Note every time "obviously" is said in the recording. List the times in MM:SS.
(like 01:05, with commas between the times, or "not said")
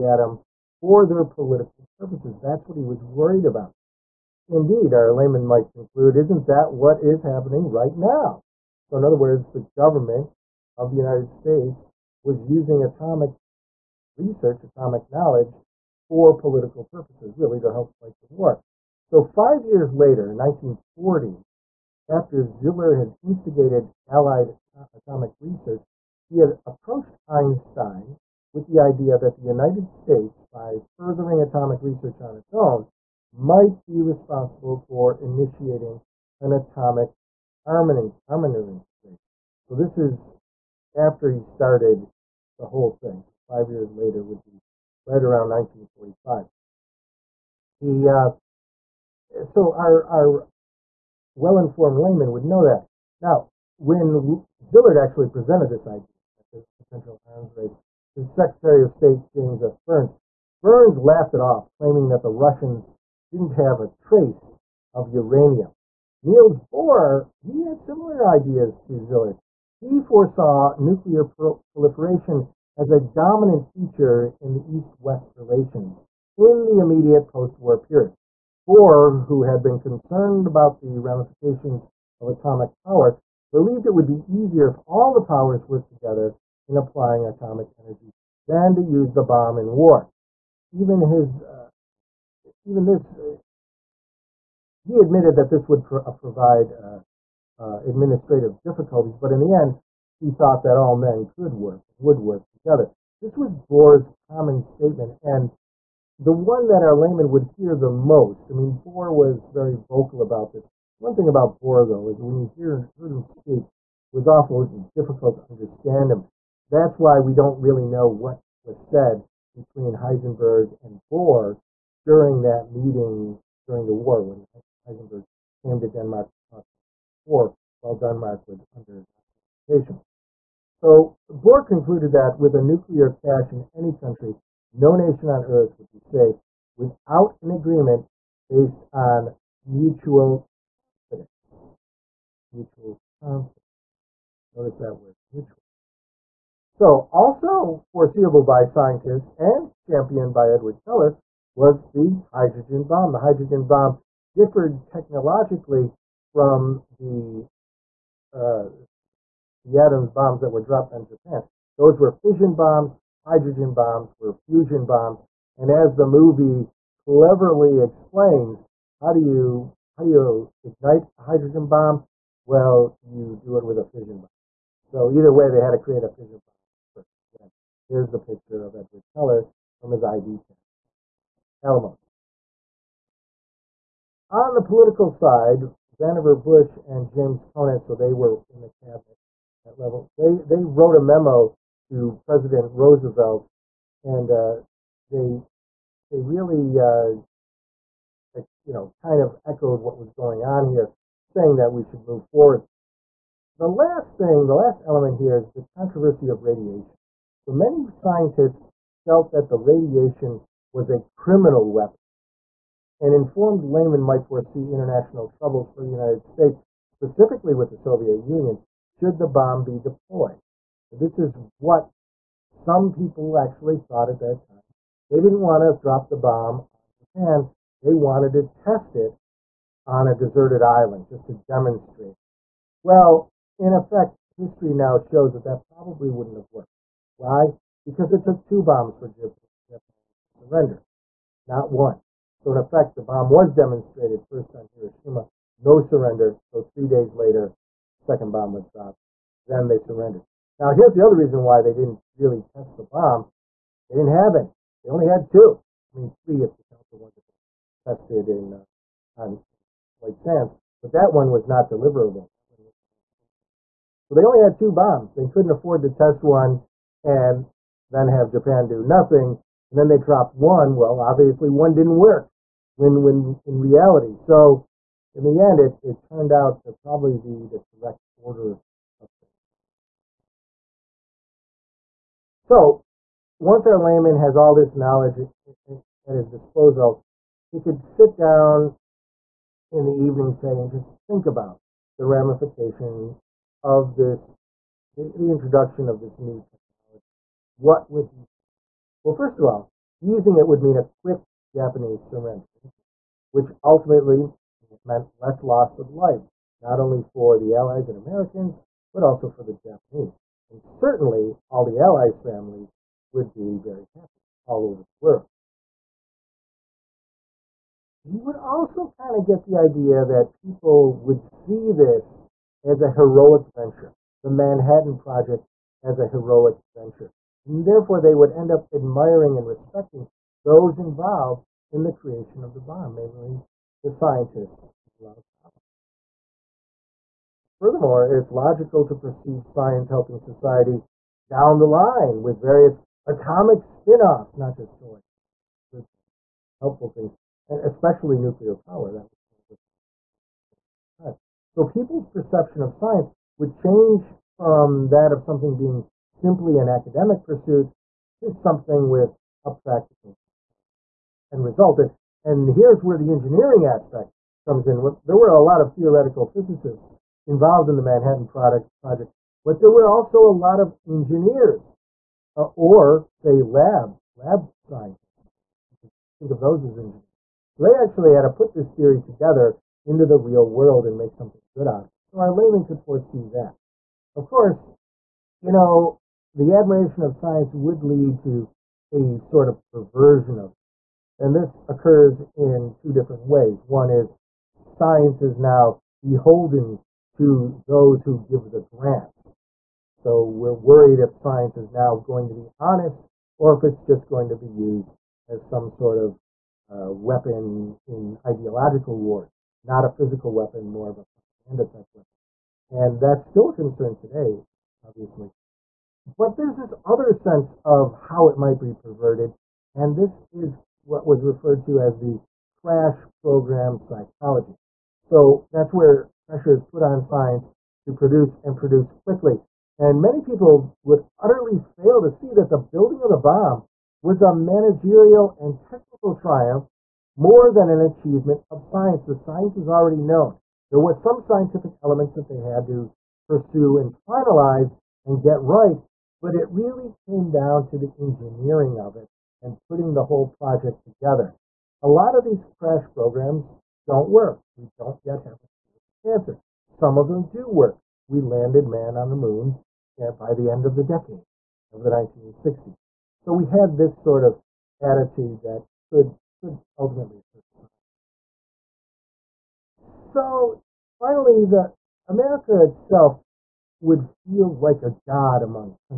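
04:30, 06:54.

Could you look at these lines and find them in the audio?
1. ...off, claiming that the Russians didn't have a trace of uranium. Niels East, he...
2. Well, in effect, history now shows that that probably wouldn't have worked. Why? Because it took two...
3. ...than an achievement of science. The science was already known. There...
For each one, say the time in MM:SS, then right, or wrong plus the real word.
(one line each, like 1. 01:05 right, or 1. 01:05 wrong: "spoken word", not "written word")
1. 01:01 wrong: "Bohr", not "East"
2. 03:52 right
3. 07:17 right.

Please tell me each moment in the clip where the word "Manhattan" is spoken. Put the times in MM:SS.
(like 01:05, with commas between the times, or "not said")
05:24, 06:07.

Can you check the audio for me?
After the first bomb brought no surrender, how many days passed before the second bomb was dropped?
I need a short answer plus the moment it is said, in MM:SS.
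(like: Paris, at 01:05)
3, at 04:06.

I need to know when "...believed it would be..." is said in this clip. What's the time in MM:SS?
01:23.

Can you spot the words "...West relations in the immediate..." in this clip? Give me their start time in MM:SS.
01:14.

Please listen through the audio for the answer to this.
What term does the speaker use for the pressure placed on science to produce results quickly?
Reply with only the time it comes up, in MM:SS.
07:02.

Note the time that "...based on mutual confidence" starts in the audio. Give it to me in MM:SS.
02:18.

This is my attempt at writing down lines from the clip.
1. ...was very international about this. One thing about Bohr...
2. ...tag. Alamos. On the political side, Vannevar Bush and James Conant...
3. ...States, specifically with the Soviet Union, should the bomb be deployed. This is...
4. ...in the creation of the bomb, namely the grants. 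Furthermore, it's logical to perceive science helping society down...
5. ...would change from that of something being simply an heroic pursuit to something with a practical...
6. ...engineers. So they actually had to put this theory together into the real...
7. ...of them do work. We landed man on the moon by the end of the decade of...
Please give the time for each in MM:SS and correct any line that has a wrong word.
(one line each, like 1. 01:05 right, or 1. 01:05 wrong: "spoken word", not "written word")
1. 01:49 wrong: "vocal", not "international"
2. 03:00 right
3. 03:36 right
4. 05:31 wrong: "scientists", not "grants"
5. 05:53 wrong: "academic", not "heroic"
6. 06:16 right
7. 07:36 right.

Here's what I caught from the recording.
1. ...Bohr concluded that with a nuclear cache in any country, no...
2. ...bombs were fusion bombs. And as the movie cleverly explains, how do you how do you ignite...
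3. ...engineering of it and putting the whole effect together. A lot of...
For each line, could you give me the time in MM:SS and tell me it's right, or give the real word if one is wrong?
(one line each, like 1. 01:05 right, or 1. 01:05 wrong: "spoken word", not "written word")
1. 02:11 right
2. 02:43 right
3. 07:27 wrong: "project", not "effect".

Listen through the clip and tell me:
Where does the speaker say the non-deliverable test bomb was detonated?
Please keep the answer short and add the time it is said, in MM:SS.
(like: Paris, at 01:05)
White Sands, at 04:19.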